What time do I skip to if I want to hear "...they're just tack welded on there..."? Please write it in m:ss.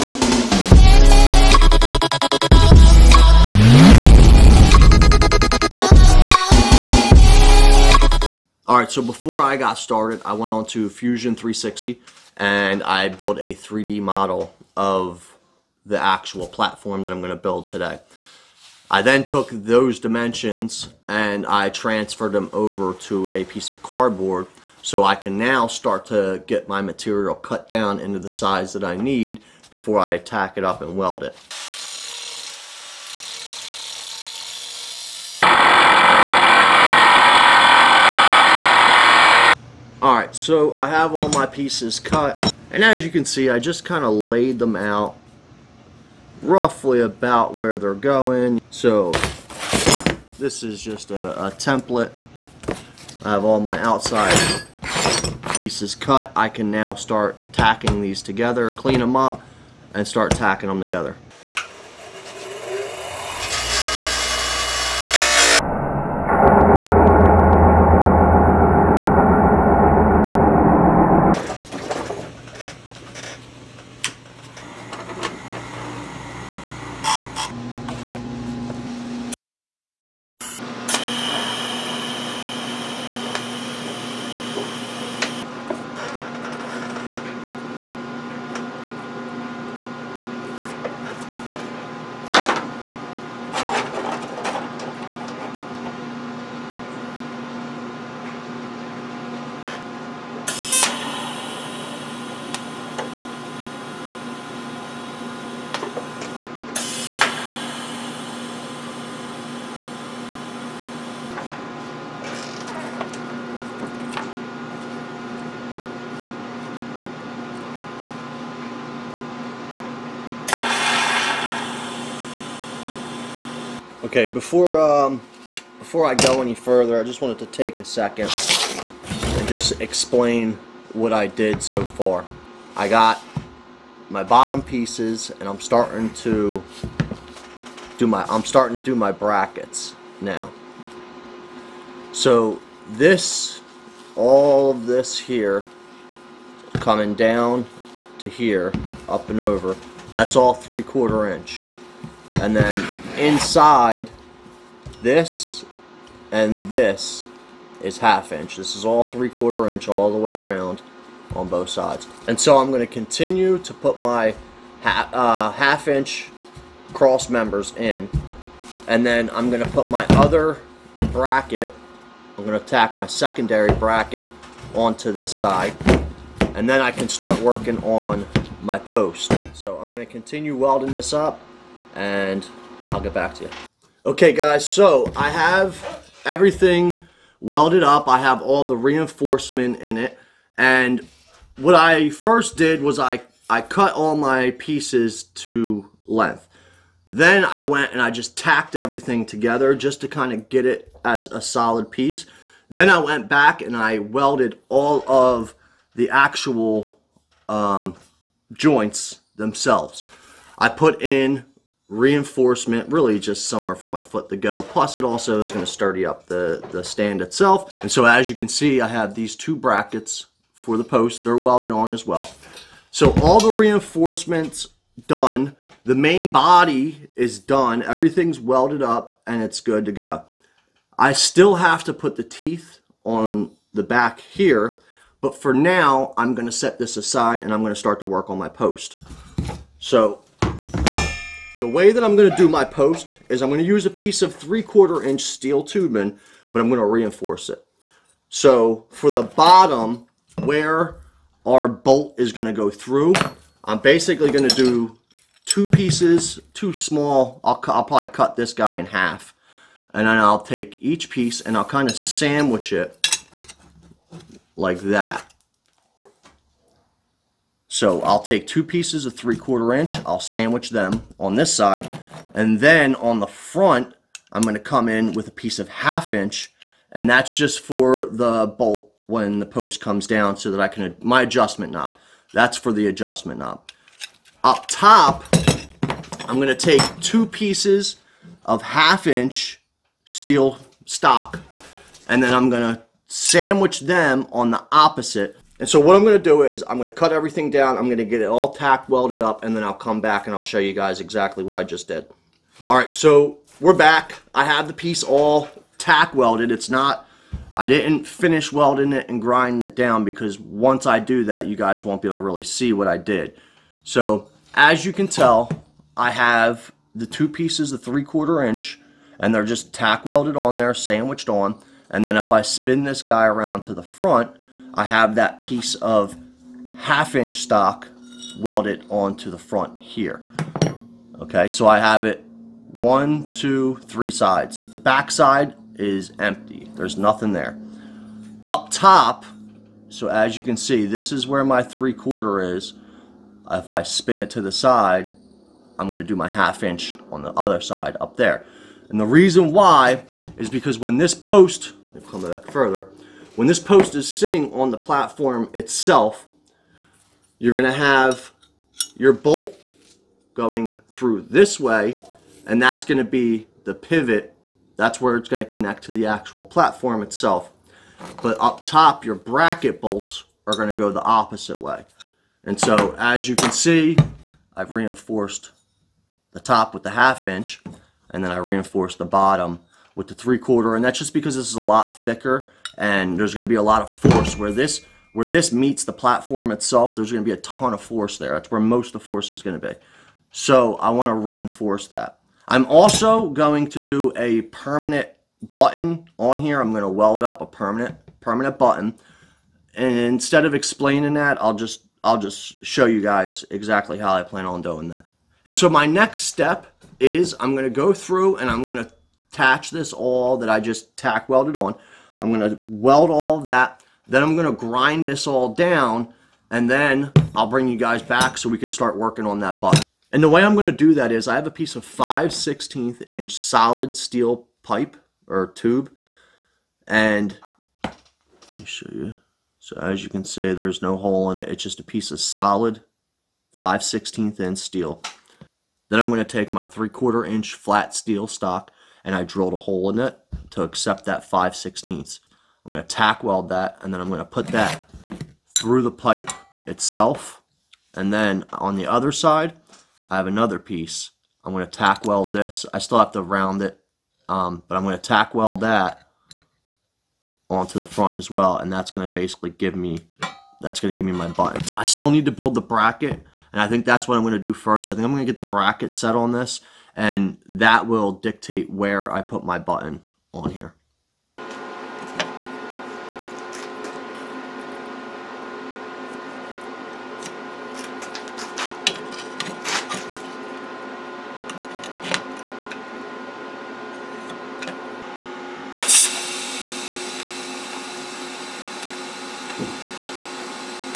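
5:19.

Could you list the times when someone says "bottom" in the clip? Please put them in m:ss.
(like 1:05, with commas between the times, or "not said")
2:14, 4:09, 6:19.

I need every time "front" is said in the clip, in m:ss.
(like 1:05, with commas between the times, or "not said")
4:33, 5:23, 5:29, 7:37.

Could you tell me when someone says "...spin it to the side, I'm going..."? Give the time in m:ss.
5:43.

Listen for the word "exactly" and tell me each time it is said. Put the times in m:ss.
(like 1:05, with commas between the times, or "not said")
5:00, 6:43.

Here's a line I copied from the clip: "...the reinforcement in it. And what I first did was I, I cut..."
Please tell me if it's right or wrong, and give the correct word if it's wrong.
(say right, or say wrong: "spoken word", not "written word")
right.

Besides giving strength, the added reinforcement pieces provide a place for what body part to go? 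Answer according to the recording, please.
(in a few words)
foot.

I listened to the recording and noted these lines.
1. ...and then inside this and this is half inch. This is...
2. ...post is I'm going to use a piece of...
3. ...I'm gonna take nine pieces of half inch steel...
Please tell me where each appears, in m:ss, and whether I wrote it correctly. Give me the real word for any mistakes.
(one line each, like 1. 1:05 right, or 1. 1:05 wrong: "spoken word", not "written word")
1. 2:32 right
2. 4:02 right
3. 4:46 wrong: "two", not "nine".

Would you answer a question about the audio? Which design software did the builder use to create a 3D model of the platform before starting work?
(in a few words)
Fusion 360.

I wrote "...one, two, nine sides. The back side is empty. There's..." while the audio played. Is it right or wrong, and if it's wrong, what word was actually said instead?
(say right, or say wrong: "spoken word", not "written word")
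wrong: "three", not "nine".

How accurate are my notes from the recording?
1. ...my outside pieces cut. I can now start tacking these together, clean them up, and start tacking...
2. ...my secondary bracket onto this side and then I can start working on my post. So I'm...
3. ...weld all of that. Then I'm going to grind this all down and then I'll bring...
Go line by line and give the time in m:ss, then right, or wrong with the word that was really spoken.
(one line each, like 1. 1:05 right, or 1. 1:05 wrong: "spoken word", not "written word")
1. 0:53 right
2. 2:52 right
3. 6:52 right.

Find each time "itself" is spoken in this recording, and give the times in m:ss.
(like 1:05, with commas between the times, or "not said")
3:37, 5:55, 6:07, 6:26, 7:26.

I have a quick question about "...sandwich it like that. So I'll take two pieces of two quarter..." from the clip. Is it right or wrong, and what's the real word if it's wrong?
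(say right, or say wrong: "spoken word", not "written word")
wrong: "three", not "two".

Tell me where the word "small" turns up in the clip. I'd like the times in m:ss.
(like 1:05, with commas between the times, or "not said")
4:16.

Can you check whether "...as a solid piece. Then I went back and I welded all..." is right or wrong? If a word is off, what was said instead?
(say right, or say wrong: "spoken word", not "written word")
right.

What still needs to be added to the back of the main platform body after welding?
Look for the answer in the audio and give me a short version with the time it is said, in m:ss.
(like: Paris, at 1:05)
the teeth, at 3:52.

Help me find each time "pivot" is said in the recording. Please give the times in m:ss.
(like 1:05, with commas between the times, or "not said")
6:03.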